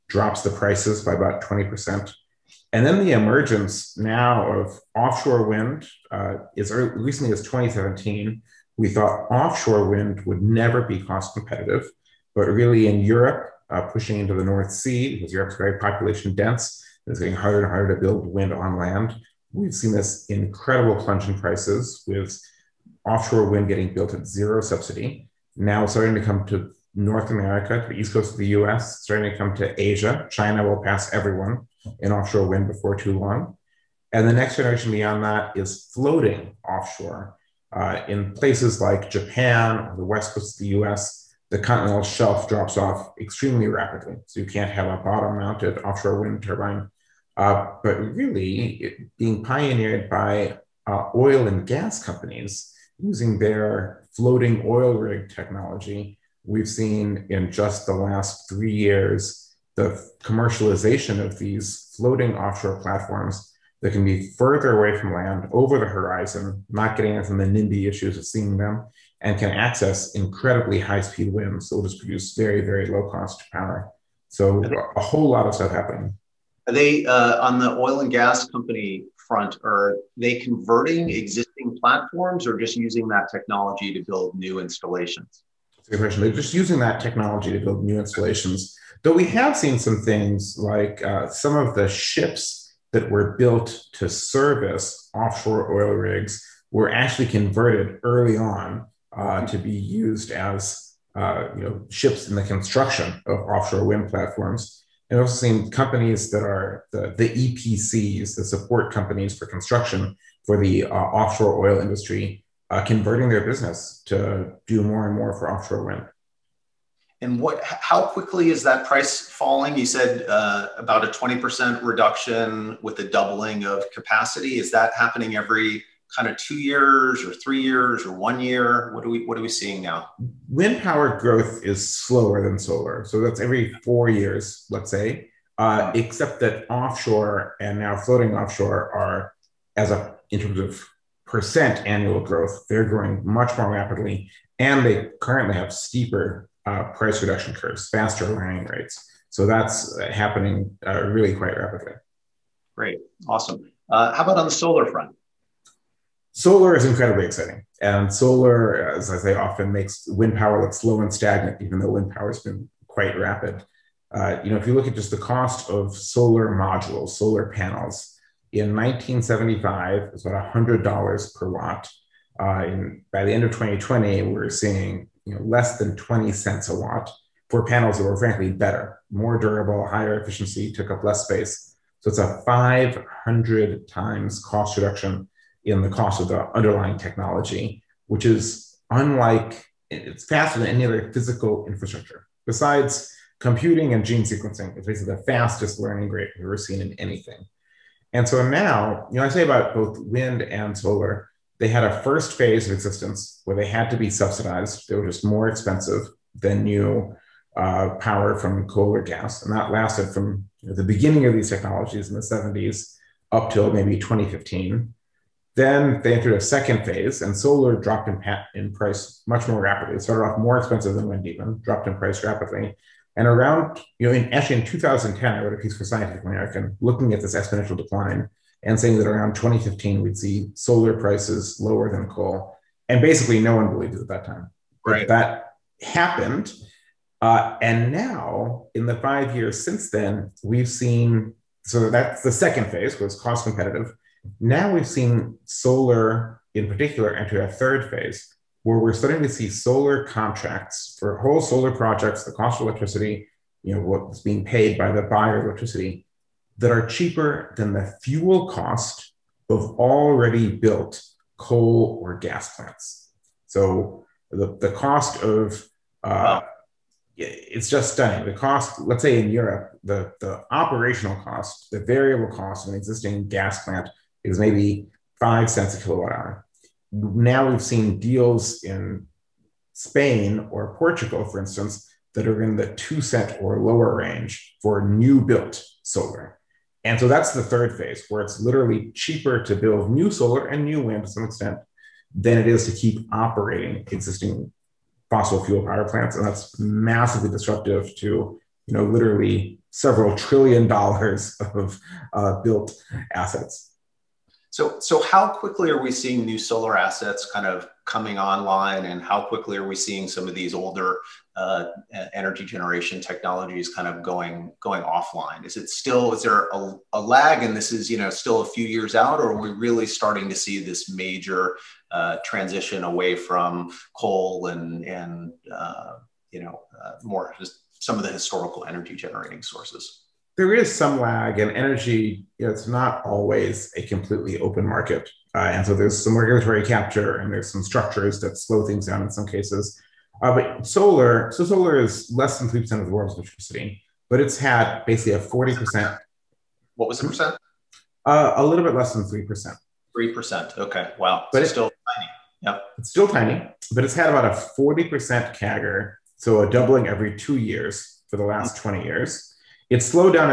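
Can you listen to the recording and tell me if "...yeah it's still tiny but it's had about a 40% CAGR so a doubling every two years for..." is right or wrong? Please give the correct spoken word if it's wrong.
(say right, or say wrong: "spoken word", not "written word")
right.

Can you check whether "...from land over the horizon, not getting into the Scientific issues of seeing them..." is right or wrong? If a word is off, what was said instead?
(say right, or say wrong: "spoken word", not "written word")
wrong: "NIMBY", not "Scientific".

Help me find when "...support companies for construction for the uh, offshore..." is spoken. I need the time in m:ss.
1:48.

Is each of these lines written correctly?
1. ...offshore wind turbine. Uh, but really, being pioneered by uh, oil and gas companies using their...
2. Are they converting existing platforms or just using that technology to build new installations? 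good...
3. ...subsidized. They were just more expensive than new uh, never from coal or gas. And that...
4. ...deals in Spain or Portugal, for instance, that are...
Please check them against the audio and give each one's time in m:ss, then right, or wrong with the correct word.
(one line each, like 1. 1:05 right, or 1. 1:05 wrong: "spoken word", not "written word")
1. 0:45 right
2. 1:19 right
3. 3:24 wrong: "power", not "never"
4. 4:37 right.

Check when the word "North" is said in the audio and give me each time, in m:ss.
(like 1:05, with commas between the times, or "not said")
0:14, 0:26.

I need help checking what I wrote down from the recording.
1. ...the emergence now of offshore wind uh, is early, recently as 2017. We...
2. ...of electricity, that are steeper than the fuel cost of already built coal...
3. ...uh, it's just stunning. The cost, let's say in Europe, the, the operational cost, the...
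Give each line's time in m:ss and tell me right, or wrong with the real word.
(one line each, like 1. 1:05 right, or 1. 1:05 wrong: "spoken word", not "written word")
1. 0:03 right
2. 4:15 wrong: "cheaper", not "steeper"
3. 4:26 right.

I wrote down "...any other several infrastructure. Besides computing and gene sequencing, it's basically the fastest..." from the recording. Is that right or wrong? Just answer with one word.
wrong.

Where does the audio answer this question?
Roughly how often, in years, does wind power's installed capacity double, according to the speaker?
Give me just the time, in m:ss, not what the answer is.
2:13.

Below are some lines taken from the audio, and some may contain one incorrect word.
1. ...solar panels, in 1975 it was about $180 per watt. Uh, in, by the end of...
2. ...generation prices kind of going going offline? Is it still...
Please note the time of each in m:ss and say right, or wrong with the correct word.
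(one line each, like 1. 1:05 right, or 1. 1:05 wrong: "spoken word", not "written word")
1. 2:47 wrong: "100", not "180"
2. 5:12 wrong: "technologies", not "prices".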